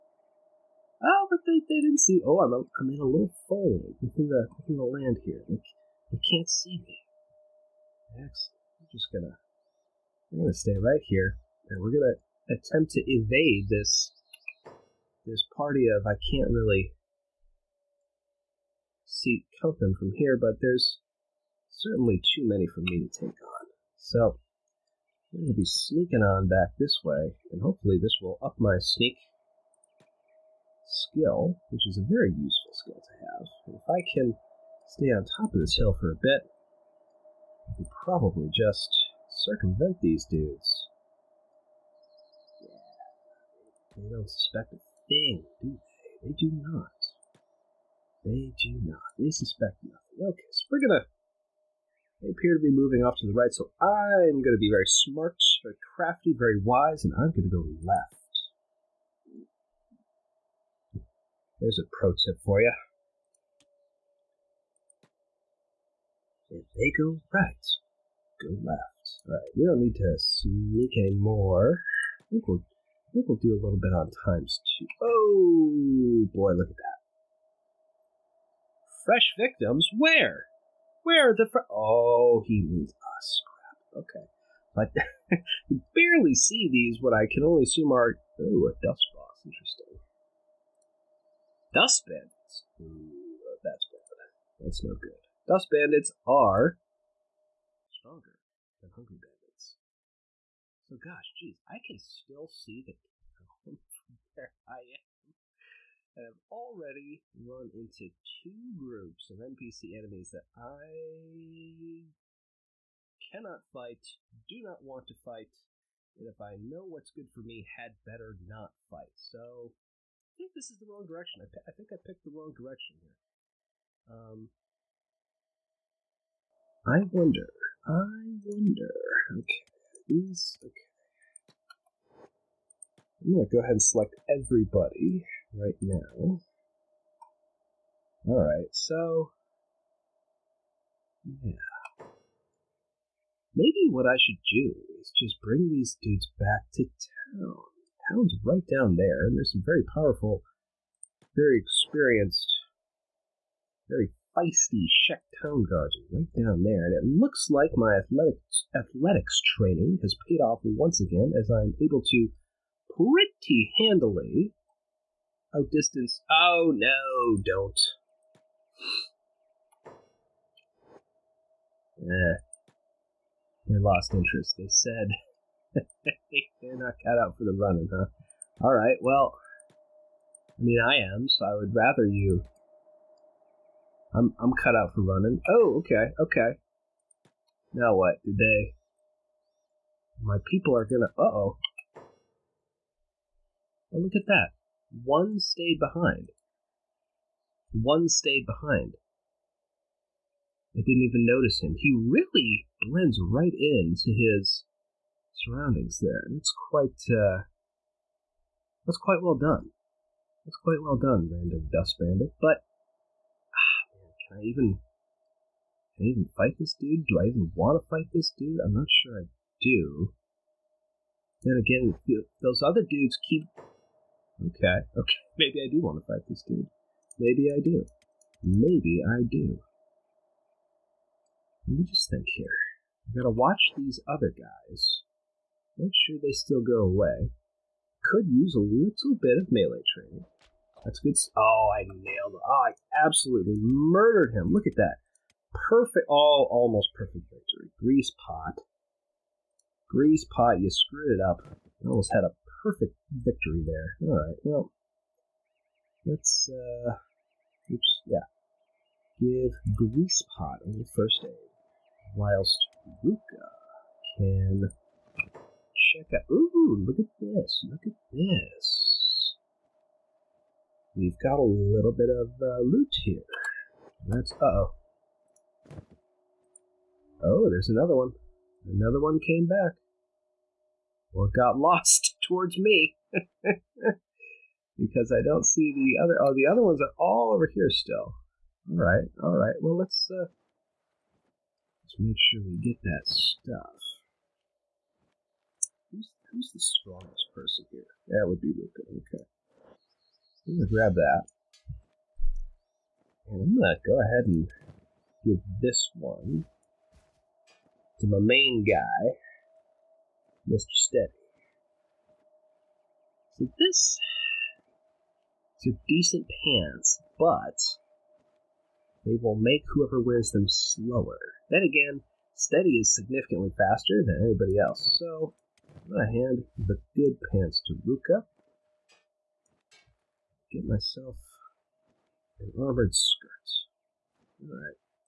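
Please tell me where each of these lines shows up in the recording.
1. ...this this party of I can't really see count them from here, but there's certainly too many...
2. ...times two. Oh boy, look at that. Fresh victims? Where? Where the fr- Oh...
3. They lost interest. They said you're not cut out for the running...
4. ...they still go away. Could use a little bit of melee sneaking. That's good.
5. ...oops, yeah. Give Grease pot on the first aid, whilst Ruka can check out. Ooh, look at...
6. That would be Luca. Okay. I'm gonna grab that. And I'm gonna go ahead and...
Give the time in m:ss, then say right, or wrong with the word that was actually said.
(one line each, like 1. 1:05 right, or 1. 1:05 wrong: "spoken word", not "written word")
1. 0:13 right
2. 1:14 right
3. 2:53 right
4. 3:56 wrong: "training", not "sneaking"
5. 4:17 right
6. 4:58 right.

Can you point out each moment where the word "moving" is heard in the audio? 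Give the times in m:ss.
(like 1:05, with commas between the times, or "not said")
0:52.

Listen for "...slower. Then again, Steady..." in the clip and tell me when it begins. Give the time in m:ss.
5:20.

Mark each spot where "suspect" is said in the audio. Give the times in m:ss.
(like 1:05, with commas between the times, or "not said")
0:44, 0:49.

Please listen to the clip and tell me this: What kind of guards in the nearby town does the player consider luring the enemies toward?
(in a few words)
Shek Town guards.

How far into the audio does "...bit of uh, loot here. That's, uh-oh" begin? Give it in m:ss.
4:31.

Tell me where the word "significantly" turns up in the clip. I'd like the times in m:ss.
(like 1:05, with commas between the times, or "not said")
5:22.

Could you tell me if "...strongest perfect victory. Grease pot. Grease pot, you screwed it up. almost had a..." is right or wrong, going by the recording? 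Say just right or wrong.
wrong.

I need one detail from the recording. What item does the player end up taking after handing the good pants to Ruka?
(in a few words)
Armored skirt.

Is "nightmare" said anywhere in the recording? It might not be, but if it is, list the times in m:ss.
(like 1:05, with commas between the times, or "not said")
not said.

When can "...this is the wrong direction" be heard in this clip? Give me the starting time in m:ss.
2:00.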